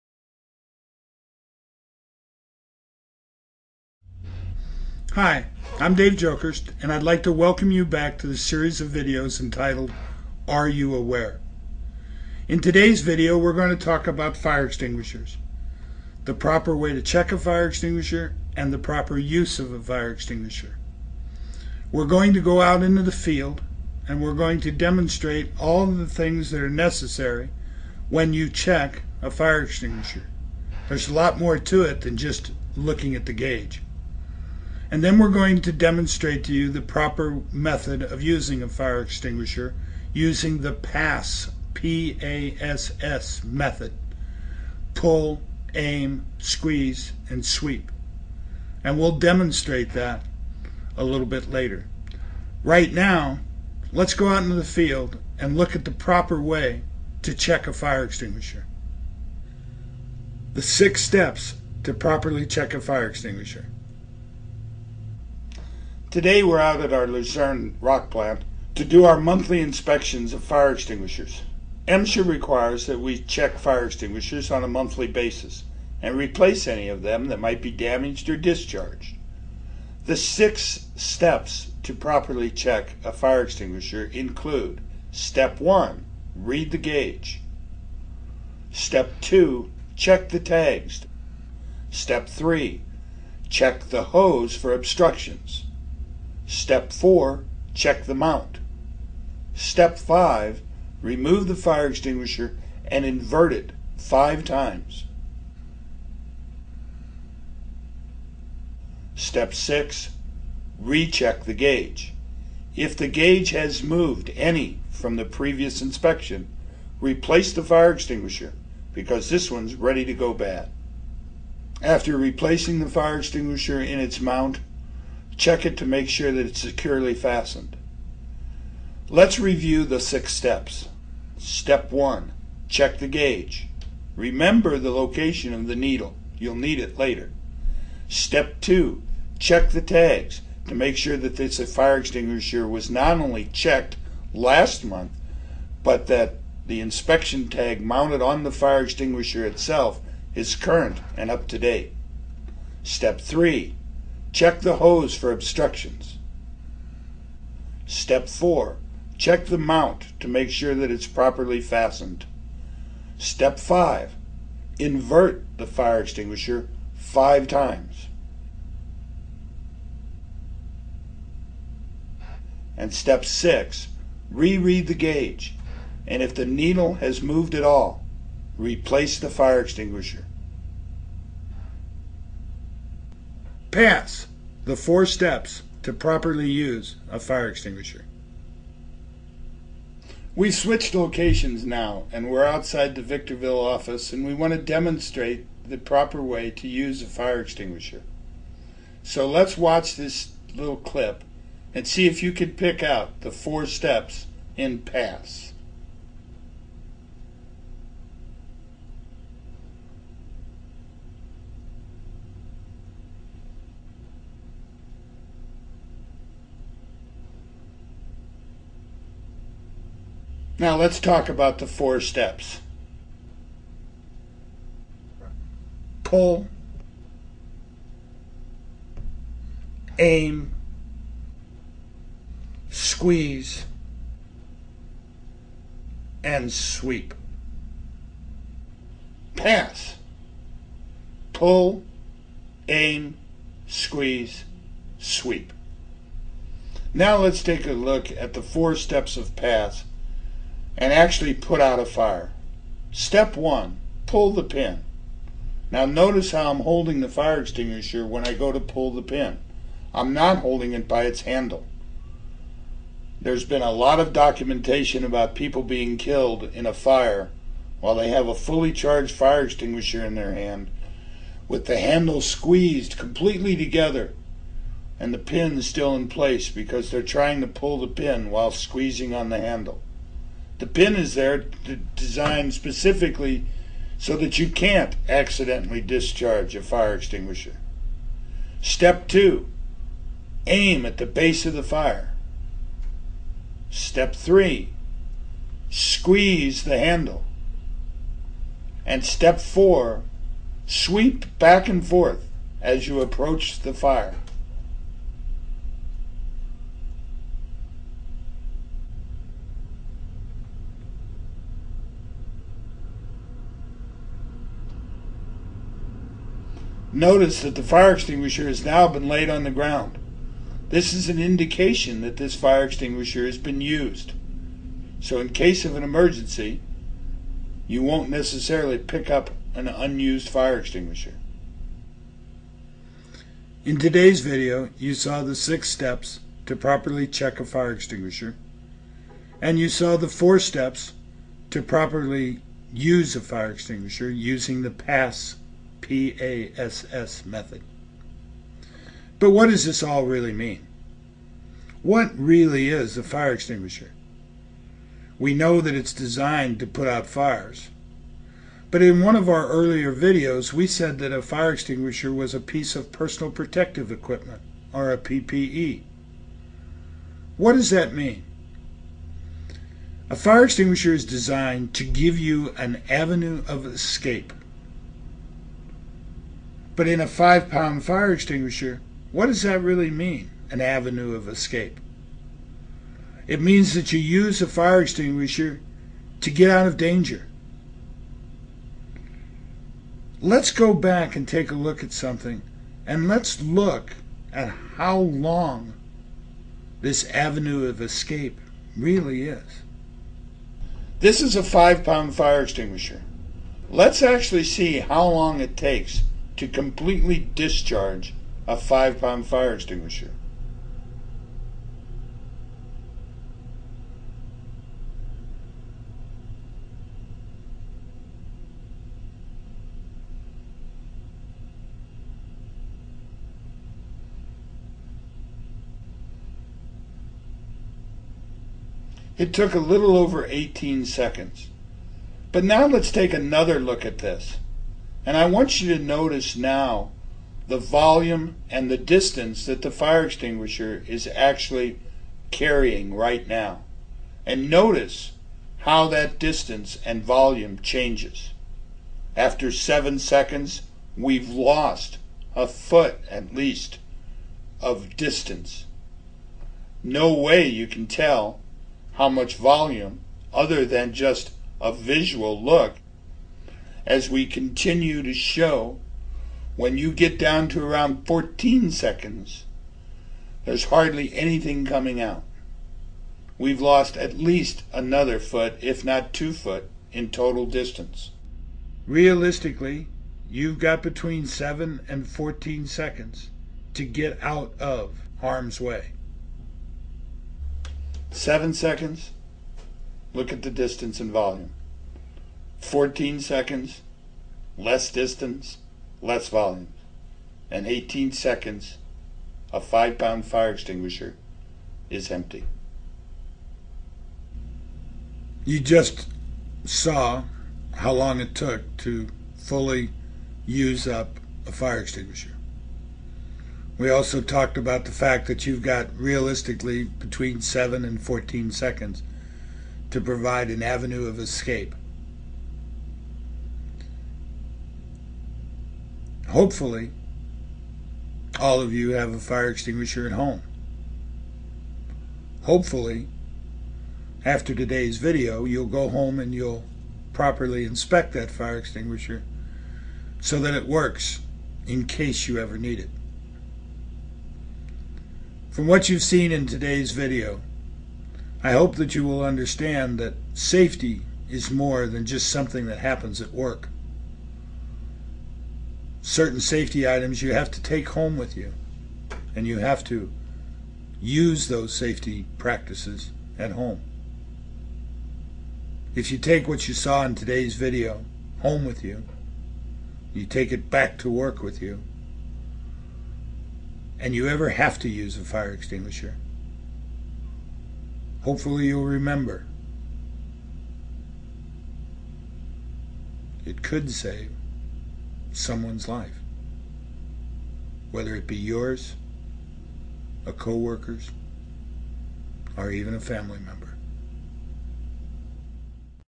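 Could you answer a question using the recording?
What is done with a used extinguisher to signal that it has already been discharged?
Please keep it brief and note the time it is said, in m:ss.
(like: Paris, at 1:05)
laid on the ground, at 5:19.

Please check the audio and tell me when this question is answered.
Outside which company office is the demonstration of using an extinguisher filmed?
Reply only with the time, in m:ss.
3:13.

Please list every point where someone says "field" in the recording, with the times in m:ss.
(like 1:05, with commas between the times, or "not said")
0:23, 0:54.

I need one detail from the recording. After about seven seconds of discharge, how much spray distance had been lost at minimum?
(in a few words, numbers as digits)
a foot.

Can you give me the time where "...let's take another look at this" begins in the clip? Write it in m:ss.
7:12.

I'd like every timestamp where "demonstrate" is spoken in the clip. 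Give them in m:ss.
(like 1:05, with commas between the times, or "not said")
0:24, 0:35, 0:49, 3:14.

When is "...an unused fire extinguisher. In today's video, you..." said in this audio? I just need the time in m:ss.
5:29.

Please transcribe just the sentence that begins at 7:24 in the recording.
And notice how that distance and volume changes.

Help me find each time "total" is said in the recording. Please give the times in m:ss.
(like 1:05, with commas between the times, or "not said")
7:57.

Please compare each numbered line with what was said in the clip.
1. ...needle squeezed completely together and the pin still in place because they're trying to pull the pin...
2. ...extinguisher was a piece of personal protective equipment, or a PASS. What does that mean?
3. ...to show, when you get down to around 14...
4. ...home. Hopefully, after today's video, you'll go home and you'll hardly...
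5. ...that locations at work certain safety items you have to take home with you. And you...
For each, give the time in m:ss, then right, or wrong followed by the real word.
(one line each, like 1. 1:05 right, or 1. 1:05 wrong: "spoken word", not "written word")
1. 4:31 wrong: "handle", not "needle"
2. 6:01 wrong: "PPE", not "PASS"
3. 7:45 right
4. 8:50 wrong: "properly", not "hardly"
5. 9:12 wrong: "happens", not "locations".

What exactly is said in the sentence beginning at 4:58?
And step four, sweep back and forth as you approach the fire.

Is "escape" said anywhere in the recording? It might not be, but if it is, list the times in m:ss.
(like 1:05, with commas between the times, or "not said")
6:13, 6:21, 6:37, 8:41.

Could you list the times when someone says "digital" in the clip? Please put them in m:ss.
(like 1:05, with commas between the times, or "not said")
not said.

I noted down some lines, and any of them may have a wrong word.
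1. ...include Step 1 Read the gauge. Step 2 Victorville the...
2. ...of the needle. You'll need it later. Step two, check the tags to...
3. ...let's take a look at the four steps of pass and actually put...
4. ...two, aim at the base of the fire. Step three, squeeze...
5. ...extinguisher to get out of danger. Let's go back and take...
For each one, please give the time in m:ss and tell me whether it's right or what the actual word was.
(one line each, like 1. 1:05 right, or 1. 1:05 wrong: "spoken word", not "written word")
1. 1:24 wrong: "Check", not "Victorville"
2. 2:15 right
3. 4:07 right
4. 4:49 right
5. 6:24 right.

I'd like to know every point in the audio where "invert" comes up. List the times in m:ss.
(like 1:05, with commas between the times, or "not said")
1:43, 2:44.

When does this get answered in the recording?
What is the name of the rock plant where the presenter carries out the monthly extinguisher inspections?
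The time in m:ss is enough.
1:07.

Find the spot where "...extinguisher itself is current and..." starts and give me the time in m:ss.
2:28.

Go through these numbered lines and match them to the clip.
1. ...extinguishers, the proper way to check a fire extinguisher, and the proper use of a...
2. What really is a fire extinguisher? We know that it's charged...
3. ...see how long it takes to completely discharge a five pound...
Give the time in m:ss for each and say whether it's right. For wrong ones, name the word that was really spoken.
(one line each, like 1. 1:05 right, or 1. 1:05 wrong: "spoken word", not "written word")
1. 0:14 right
2. 5:51 wrong: "designed", not "charged"
3. 6:44 right.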